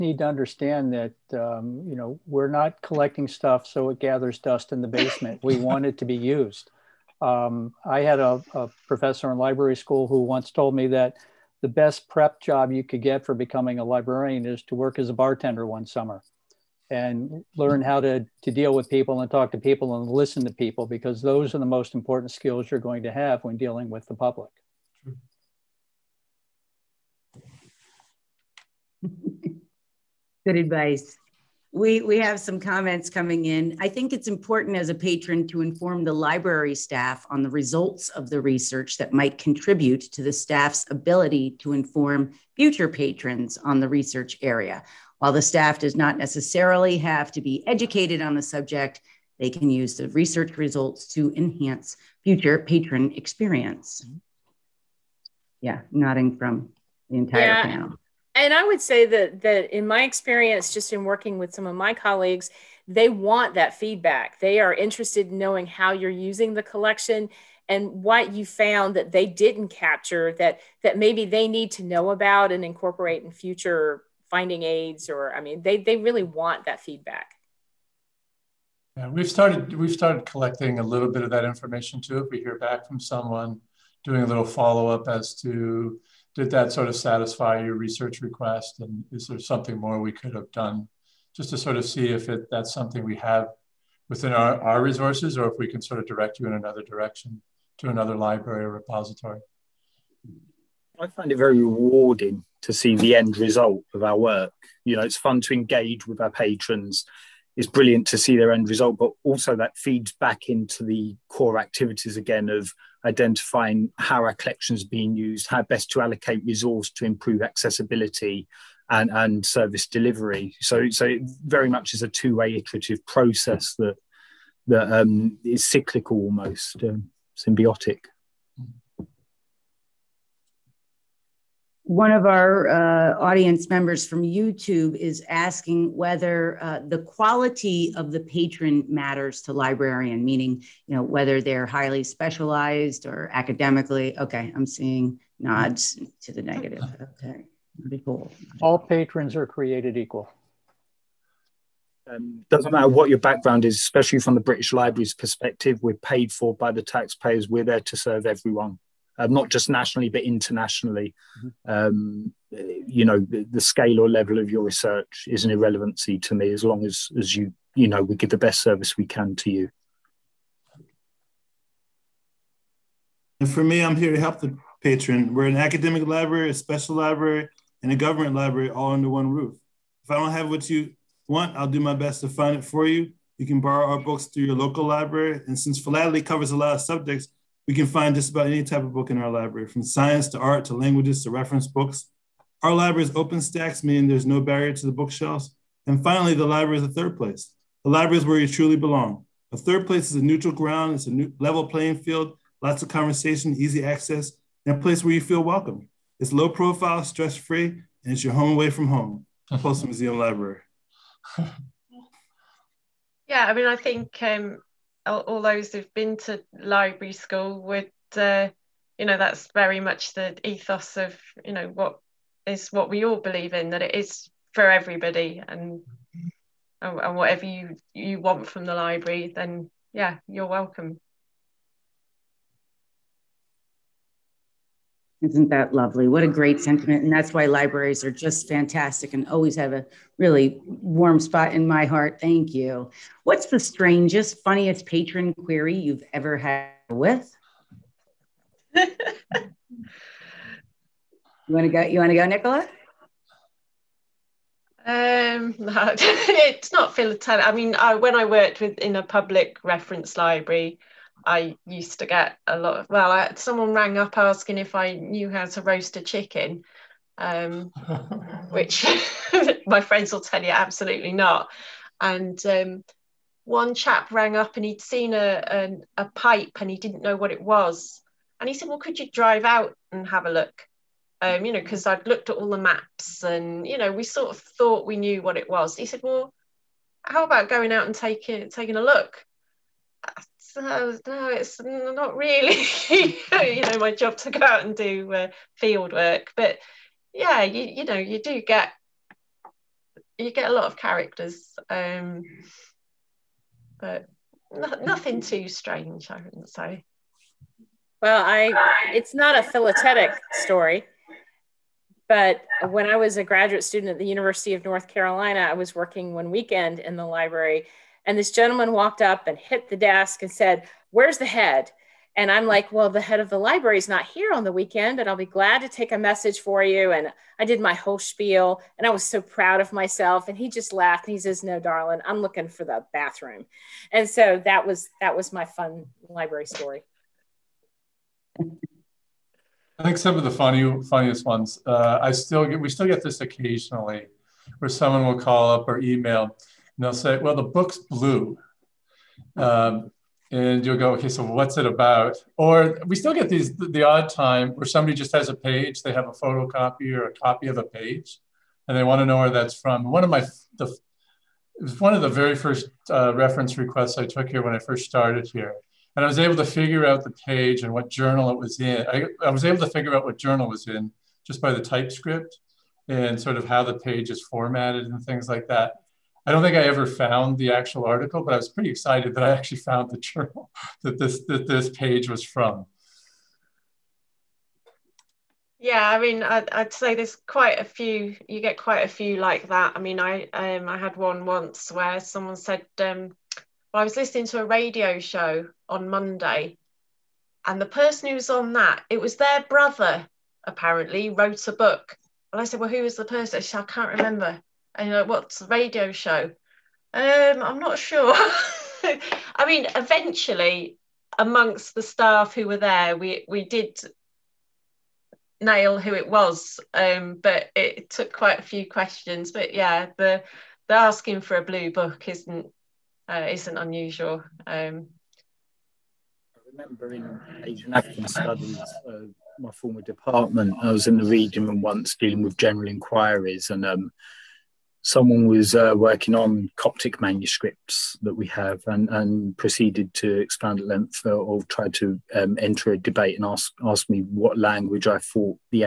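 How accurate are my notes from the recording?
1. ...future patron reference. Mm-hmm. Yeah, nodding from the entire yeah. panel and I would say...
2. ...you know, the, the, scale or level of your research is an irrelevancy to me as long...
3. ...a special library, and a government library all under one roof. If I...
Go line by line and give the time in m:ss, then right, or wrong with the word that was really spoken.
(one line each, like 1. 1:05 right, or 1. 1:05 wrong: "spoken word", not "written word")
1. 0:52 wrong: "experience", not "reference"
2. 2:42 right
3. 2:56 right.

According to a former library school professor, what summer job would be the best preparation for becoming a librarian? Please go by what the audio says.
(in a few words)
bartender.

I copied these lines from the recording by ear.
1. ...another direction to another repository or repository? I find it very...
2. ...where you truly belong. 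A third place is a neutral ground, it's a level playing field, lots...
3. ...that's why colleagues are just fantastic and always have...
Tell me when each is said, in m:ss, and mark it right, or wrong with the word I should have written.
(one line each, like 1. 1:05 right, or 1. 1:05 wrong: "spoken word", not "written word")
1. 1:36 wrong: "library", not "repository"
2. 3:18 right
3. 3:57 wrong: "libraries", not "colleagues".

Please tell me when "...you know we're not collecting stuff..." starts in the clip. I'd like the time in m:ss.
0:01.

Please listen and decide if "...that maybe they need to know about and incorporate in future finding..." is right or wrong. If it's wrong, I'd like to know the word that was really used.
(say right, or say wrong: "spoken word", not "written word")
right.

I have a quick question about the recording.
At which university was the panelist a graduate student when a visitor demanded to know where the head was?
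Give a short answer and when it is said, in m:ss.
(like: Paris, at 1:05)
University of North Carolina, at 5:14.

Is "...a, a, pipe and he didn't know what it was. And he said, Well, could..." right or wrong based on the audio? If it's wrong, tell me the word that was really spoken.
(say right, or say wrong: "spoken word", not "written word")
right.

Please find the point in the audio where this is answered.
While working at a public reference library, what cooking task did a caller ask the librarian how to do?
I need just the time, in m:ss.
4:25.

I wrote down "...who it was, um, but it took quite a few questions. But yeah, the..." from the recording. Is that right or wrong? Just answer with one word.
right.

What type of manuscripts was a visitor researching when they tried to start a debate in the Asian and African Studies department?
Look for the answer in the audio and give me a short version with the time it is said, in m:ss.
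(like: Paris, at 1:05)
Coptic, at 7:16.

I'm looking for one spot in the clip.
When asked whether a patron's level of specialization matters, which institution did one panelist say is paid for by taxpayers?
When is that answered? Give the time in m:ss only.
2:34.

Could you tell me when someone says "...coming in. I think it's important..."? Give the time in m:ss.
0:33.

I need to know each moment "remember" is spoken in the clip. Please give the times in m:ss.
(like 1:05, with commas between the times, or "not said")
6:43, 7:06.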